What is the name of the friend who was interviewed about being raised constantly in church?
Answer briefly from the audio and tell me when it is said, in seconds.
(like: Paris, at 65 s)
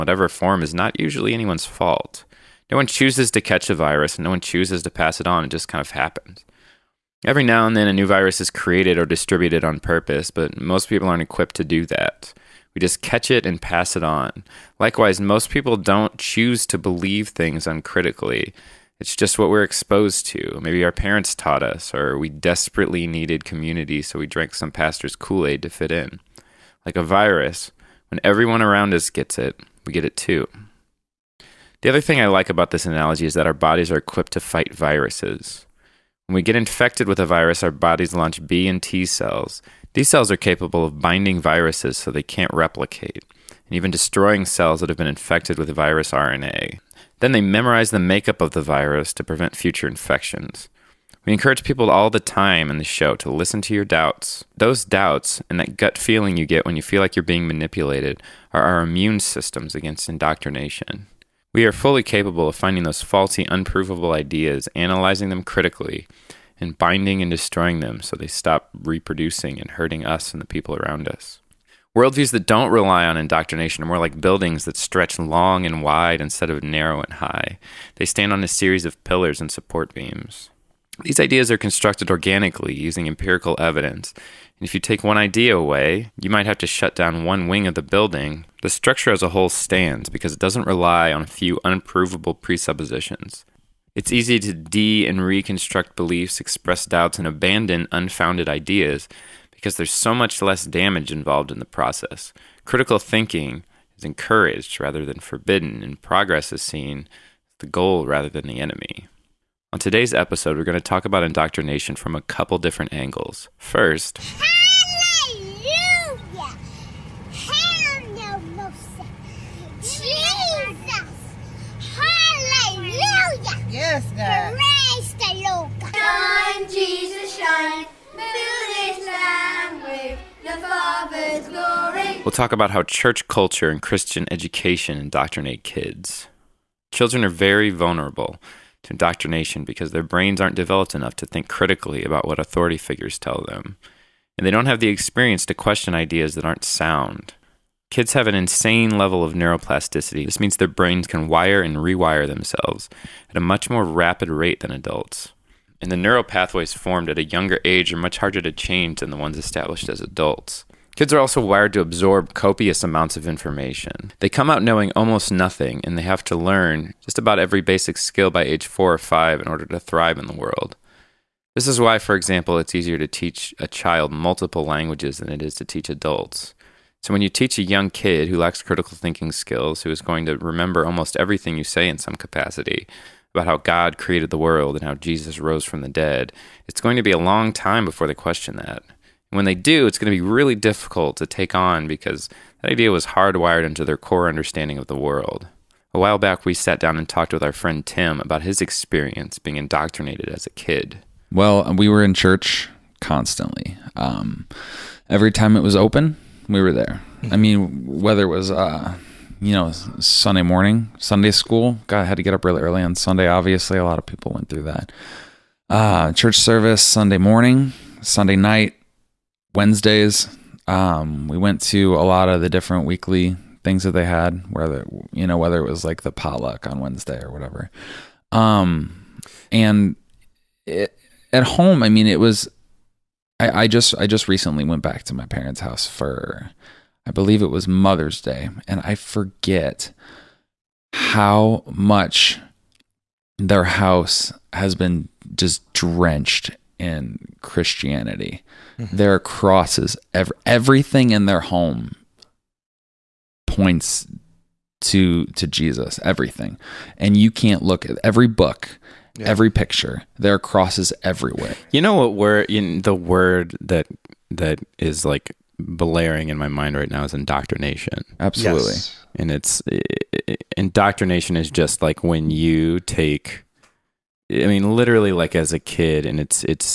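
Tim, at 197 s.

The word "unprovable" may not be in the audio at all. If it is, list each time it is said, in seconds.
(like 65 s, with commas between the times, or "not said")
63 s, 91 s.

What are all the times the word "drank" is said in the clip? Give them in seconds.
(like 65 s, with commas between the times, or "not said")
24 s.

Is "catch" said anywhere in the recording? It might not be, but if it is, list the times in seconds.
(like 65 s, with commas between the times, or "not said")
3 s, 13 s.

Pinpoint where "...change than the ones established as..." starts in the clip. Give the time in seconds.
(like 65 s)
158 s.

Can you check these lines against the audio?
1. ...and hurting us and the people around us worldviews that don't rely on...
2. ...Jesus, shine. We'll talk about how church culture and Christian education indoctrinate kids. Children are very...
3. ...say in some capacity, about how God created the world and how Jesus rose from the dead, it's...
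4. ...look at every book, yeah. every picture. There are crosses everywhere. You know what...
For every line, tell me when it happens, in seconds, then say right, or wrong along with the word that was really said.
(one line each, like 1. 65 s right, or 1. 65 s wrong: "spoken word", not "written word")
1. 69 s right
2. 126 s right
3. 181 s right
4. 257 s right.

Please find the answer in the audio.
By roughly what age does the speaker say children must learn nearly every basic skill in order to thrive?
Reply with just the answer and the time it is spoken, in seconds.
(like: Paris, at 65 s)
4 or 5, at 168 s.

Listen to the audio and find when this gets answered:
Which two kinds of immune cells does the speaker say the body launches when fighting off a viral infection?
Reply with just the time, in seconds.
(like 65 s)
38 s.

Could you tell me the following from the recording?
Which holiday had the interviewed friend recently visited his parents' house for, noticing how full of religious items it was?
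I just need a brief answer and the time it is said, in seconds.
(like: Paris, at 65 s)
Mother's Day, at 237 s.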